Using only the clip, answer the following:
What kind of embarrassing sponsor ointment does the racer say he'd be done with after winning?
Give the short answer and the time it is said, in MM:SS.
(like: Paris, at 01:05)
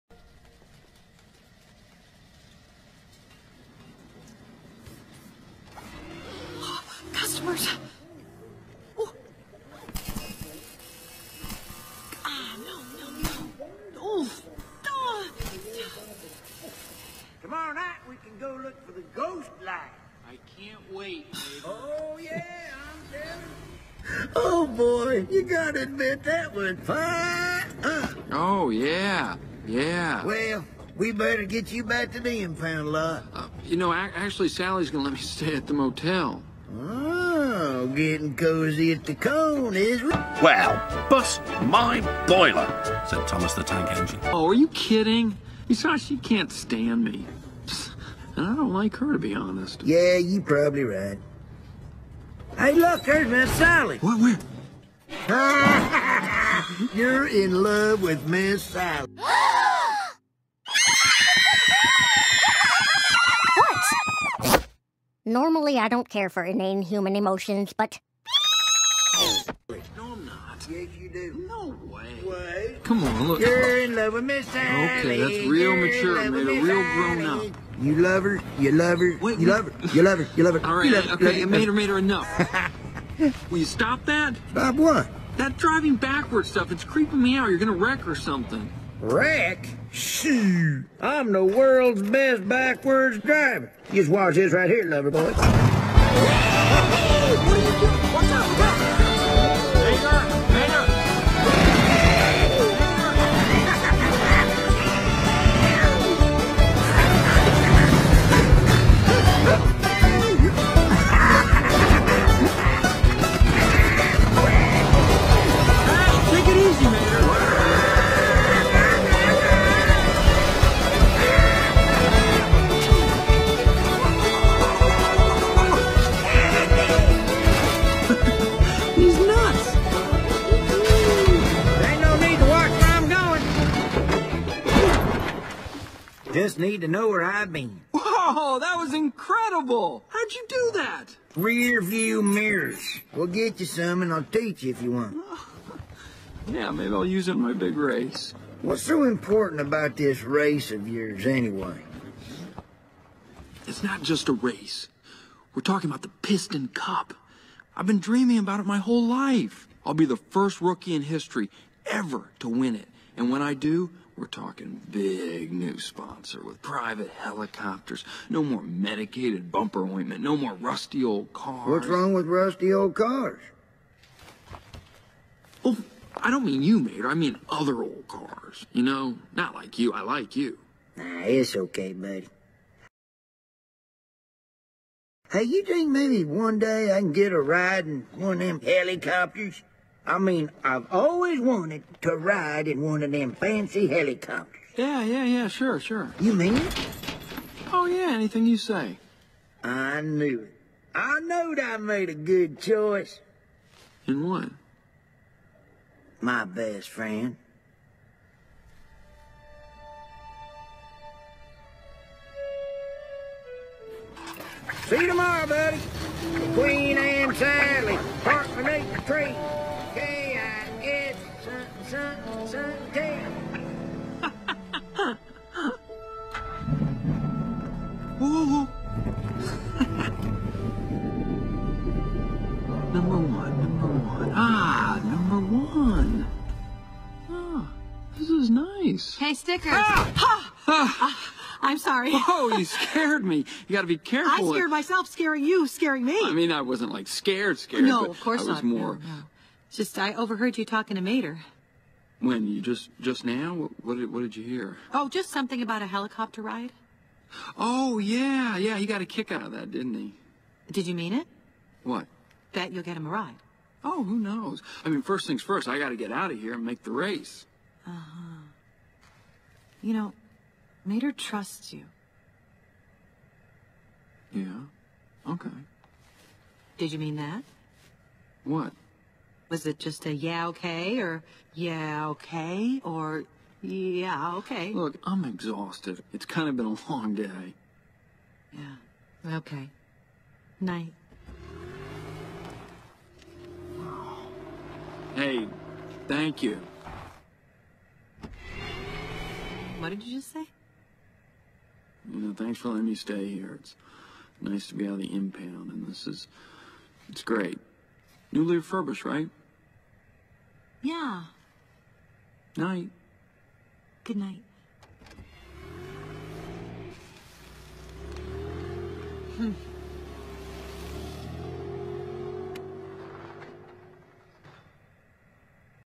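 Medicated bumper ointment, at 02:48.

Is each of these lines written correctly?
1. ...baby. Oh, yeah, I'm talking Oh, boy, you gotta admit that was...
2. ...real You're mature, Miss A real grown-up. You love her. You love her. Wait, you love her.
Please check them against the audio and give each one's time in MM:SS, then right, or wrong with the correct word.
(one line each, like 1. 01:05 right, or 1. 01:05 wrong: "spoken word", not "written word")
1. 00:21 wrong: "telling", not "talking"
2. 01:15 wrong: "Made", not "Miss".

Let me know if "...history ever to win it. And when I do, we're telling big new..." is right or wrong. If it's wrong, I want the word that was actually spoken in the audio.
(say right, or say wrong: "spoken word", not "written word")
wrong: "talking", not "telling".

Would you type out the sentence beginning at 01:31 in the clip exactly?
I'm the world's best backwards driver.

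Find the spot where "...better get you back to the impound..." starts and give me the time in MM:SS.
00:31.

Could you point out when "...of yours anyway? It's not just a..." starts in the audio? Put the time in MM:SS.
02:30.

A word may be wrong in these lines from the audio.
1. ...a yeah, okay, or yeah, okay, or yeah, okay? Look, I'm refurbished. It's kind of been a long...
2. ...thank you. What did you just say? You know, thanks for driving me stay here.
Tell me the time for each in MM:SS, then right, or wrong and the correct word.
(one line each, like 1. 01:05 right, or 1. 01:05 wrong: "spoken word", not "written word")
1. 04:40 wrong: "exhausted", not "refurbished"
2. 04:56 wrong: "letting", not "driving".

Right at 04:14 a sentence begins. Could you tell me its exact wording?
Oh, just something about a helicopter ride.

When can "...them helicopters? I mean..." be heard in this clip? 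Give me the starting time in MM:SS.
03:08.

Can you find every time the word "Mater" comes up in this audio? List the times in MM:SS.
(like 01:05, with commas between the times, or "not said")
02:56, 04:11, 04:30.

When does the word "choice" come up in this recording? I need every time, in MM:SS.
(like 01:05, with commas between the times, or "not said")
03:22.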